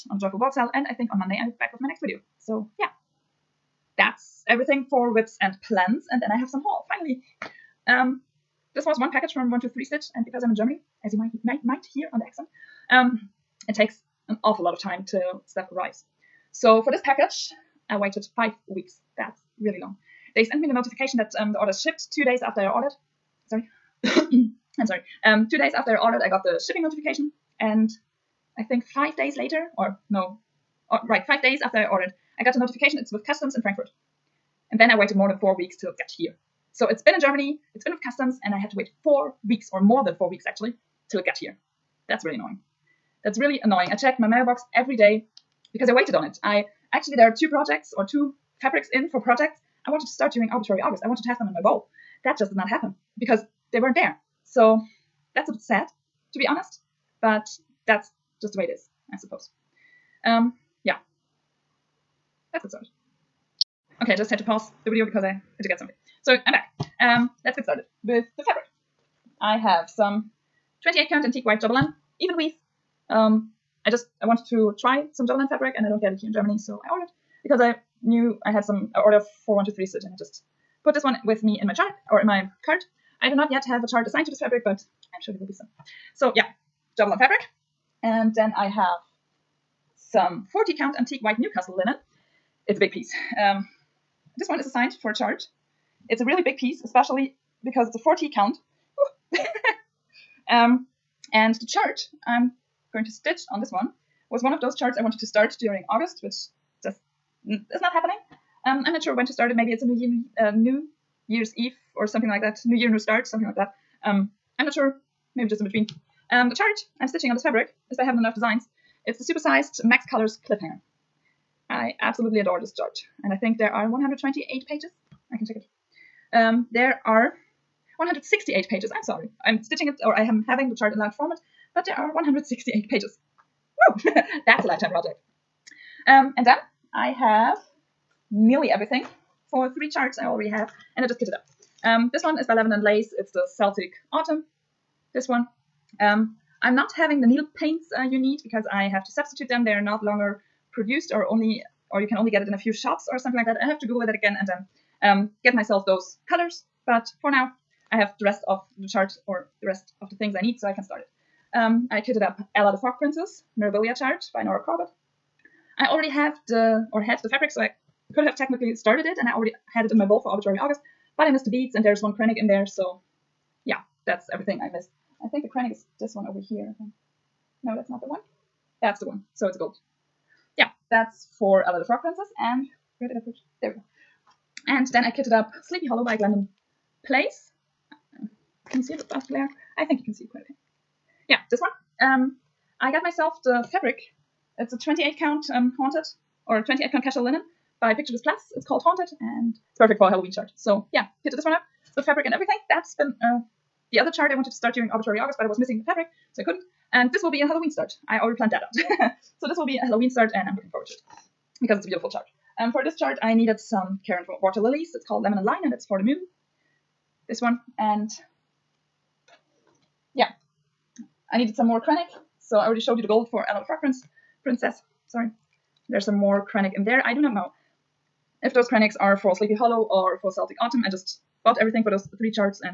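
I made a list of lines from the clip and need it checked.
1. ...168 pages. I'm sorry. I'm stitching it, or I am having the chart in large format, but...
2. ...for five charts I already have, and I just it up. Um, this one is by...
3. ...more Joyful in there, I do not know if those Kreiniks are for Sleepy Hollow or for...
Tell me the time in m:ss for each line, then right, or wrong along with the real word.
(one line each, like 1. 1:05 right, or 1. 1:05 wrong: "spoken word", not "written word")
1. 2:07 right
2. 2:19 wrong: "three", not "five"
3. 3:46 wrong: "Krennic", not "Joyful".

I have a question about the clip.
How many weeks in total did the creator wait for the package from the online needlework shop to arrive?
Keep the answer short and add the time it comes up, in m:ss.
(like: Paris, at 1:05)
5, at 0:18.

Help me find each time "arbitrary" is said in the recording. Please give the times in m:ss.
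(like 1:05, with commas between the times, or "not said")
0:50, 2:50, 3:24.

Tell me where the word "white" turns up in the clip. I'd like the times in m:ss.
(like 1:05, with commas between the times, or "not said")
1:11, 1:31.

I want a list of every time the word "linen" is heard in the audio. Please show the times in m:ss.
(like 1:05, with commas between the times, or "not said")
1:31, 3:17.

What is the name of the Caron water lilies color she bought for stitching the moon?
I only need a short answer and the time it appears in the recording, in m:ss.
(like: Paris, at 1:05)
Lemon and Lime, at 3:35.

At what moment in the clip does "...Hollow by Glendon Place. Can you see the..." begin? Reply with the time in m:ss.
3:05.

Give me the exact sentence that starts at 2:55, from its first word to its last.
I think the Kreinik is this one over here.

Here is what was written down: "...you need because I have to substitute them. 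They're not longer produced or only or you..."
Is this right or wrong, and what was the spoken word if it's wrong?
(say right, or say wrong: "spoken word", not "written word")
right.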